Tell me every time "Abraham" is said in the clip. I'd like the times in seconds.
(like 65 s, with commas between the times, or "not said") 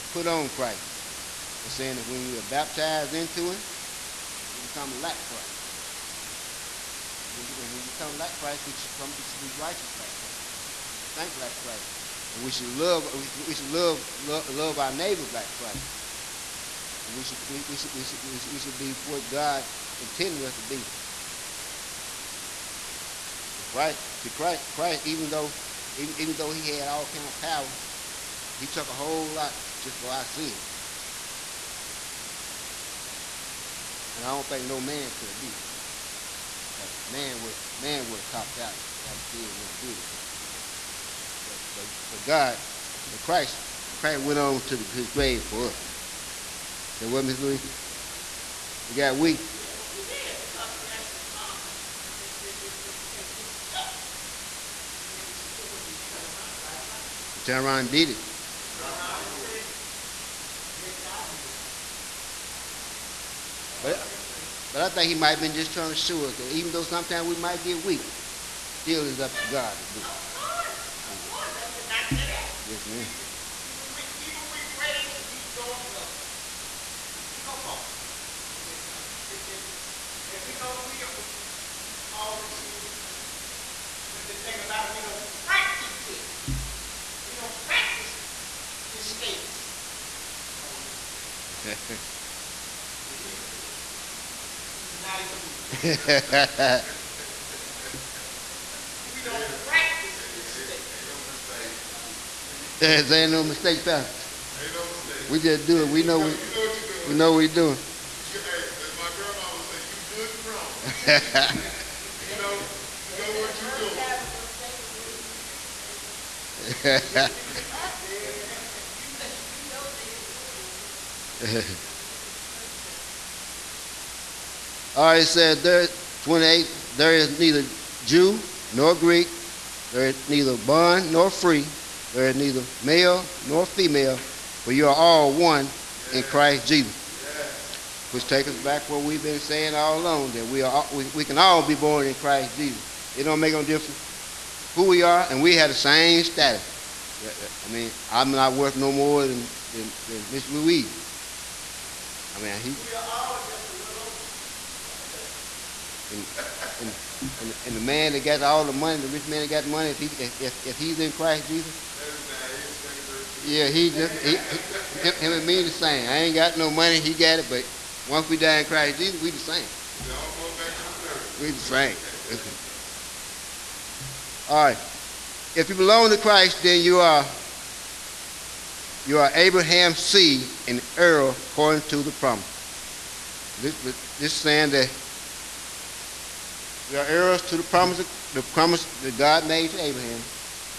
179 s, 189 s.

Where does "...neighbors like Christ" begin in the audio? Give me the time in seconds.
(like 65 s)
14 s.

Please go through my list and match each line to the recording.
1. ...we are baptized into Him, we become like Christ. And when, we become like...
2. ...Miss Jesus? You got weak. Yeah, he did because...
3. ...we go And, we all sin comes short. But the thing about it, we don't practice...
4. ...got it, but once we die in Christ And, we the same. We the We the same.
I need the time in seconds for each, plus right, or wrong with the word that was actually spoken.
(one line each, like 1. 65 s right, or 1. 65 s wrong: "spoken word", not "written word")
1. 2 s right
2. 47 s wrong: "Louis", not "Jesus"
3. 77 s right
4. 167 s wrong: "Jesus", not "And".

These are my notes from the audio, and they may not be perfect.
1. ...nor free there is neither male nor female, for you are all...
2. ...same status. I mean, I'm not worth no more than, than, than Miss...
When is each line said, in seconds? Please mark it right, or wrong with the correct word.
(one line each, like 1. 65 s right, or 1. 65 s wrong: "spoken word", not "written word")
1. 131 s right
2. 145 s right.